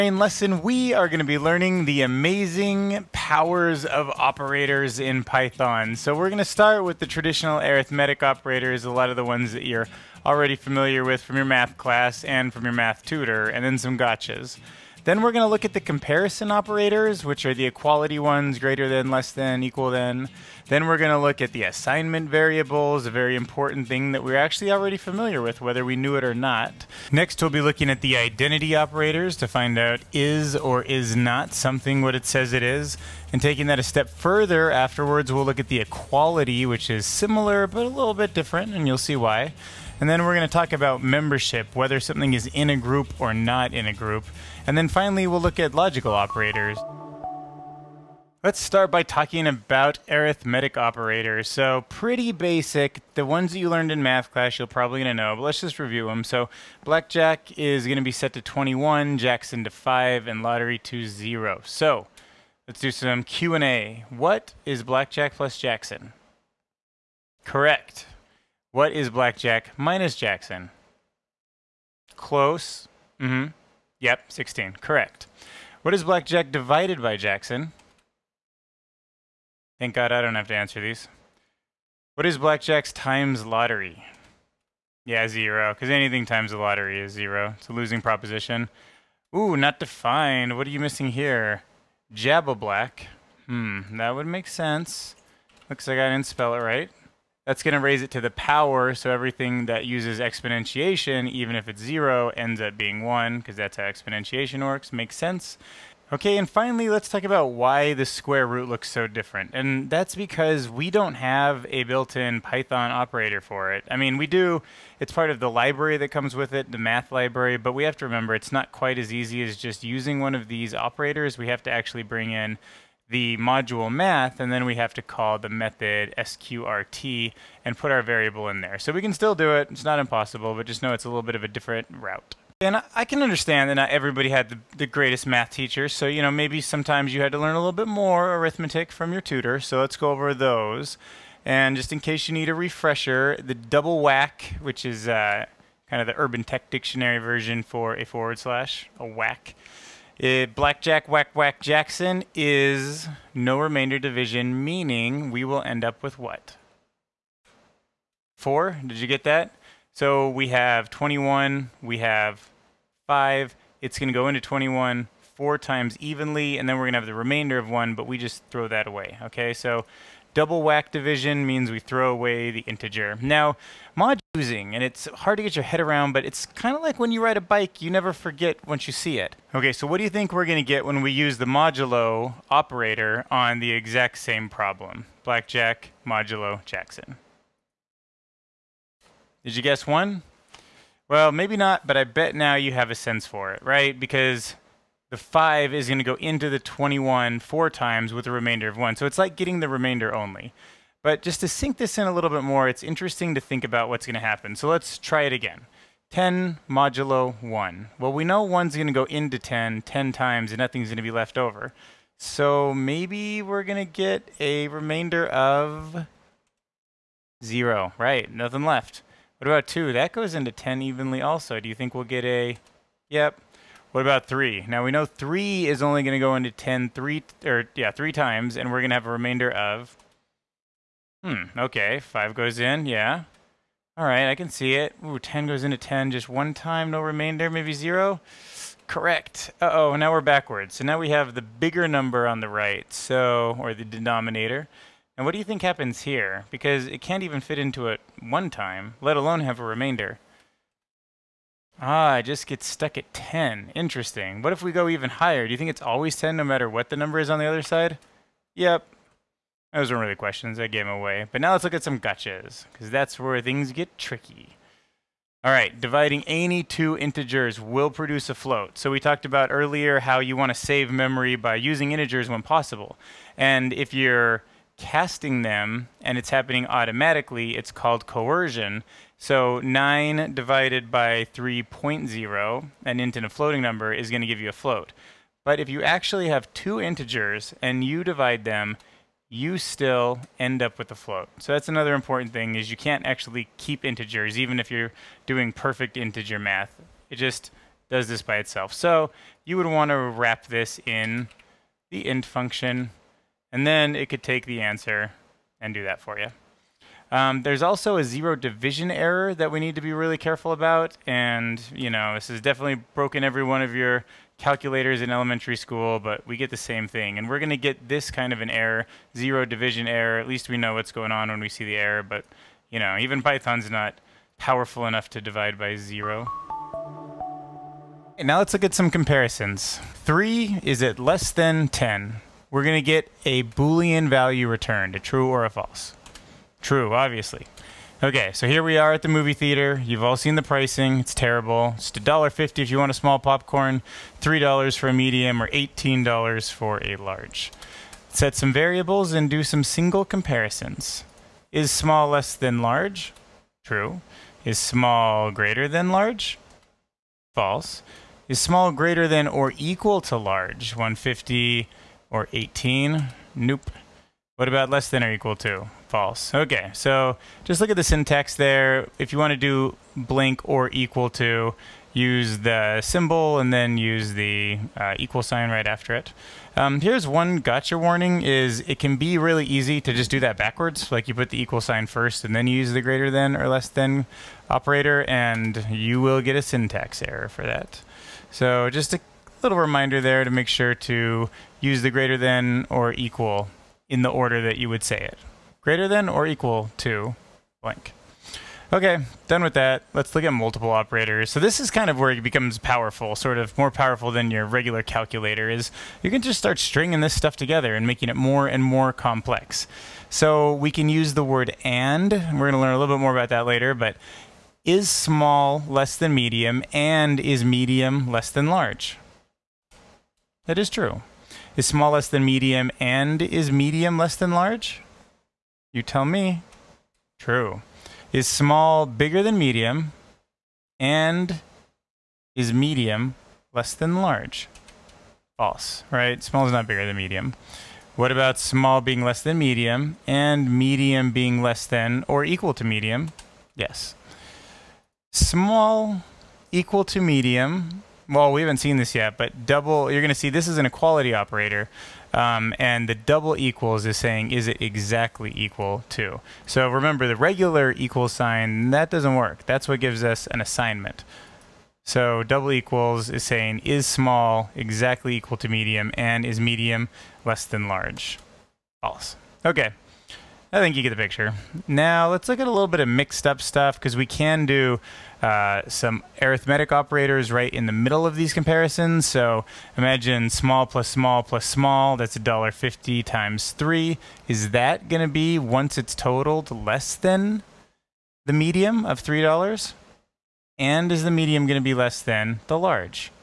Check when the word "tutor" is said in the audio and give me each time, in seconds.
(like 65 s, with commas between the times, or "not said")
13 s, 139 s.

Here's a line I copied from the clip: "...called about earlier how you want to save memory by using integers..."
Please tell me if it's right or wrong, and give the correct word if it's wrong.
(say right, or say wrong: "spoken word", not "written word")
wrong: "talked", not "called".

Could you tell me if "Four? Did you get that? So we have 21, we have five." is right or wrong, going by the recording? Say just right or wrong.
right.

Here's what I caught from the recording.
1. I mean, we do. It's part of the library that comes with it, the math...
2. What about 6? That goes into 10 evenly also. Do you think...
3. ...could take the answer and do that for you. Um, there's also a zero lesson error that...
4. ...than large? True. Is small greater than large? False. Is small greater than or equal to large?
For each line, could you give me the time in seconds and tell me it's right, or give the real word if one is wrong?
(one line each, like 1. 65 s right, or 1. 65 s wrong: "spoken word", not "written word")
1. 113 s right
2. 219 s wrong: "2", not "6"
3. 304 s wrong: "division", not "lesson"
4. 352 s right.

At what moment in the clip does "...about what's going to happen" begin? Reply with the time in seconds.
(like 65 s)
203 s.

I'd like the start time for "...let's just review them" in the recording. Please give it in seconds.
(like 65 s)
55 s.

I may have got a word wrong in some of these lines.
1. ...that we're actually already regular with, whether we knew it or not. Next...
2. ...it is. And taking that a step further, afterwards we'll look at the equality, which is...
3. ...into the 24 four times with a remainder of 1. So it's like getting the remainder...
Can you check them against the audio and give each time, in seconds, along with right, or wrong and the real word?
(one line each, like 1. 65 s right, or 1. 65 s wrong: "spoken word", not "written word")
1. 24 s wrong: "familiar", not "regular"
2. 32 s right
3. 196 s wrong: "21", not "24".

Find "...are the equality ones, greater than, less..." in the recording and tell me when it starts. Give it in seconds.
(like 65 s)
17 s.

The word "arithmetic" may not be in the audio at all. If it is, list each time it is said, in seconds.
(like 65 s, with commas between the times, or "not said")
7 s, 50 s, 138 s, 476 s.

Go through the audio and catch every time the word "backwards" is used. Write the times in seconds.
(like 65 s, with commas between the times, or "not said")
240 s, 380 s.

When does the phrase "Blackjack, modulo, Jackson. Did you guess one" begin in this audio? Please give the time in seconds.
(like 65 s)
185 s.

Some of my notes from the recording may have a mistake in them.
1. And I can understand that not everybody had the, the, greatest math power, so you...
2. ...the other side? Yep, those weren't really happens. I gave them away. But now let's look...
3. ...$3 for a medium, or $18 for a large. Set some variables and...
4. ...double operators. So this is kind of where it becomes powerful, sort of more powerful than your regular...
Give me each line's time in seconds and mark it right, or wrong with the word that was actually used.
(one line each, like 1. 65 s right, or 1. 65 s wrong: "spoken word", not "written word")
1. 132 s wrong: "teacher", not "power"
2. 257 s wrong: "questions", not "happens"
3. 344 s right
4. 400 s wrong: "multiple", not "double".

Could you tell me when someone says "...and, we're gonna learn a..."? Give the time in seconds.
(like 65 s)
411 s.